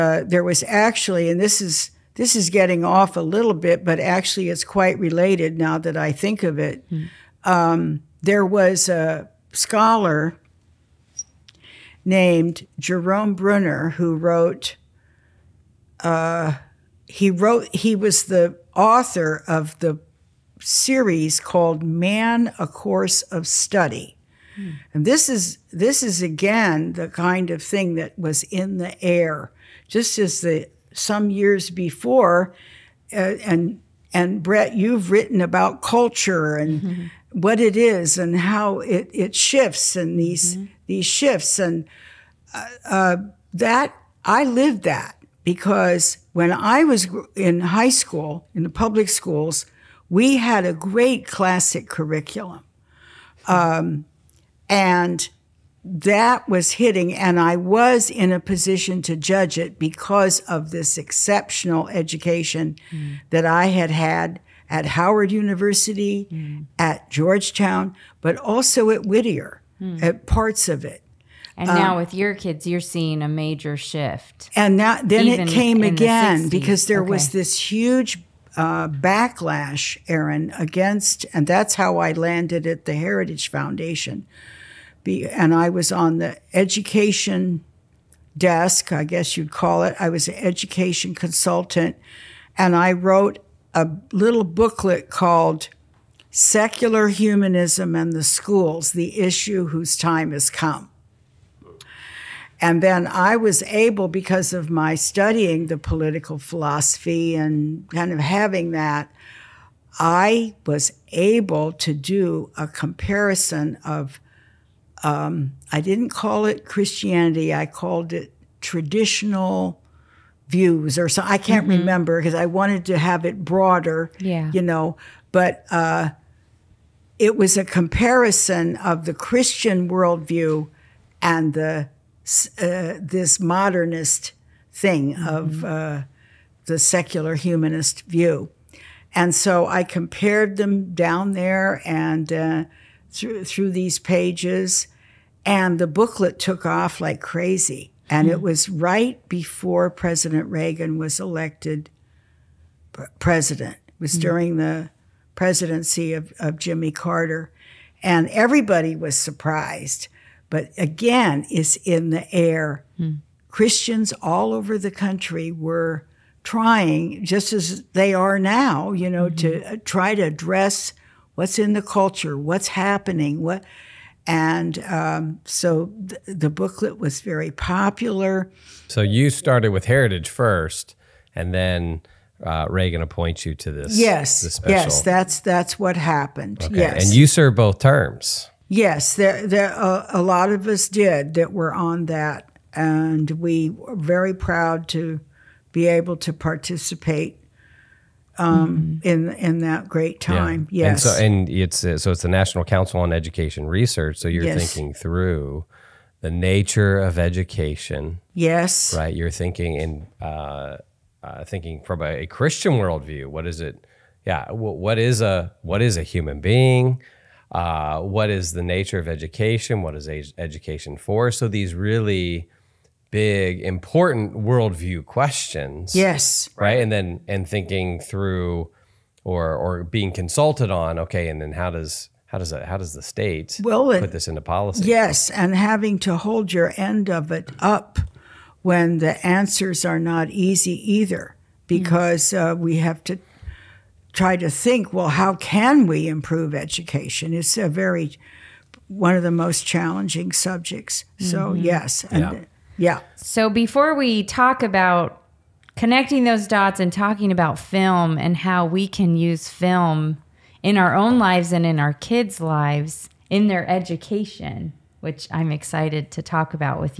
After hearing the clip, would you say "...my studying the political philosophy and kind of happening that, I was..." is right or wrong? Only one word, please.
wrong.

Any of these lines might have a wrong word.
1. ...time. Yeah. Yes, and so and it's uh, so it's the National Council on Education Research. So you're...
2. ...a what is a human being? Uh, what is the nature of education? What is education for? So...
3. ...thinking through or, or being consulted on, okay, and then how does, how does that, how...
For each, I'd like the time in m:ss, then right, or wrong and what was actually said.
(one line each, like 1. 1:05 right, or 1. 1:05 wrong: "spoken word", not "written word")
1. 3:20 right
2. 3:35 right
3. 3:47 right.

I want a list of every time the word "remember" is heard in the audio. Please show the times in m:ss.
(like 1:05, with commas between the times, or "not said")
2:01.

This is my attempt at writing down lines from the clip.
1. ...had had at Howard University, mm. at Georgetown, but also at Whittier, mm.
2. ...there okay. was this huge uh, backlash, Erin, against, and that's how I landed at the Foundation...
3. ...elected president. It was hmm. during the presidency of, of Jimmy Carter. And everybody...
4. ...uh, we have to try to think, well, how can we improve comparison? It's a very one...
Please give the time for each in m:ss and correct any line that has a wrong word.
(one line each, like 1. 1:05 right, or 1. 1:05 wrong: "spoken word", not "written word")
1. 1:03 right
2. 1:16 wrong: "Heritage", not "Foundation"
3. 2:31 right
4. 4:02 wrong: "education", not "comparison".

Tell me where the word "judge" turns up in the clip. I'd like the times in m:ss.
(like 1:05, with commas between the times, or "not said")
0:59.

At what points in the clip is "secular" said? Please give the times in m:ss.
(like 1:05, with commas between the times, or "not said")
1:36, 2:16.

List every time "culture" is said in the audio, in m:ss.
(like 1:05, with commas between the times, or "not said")
0:35, 2:51.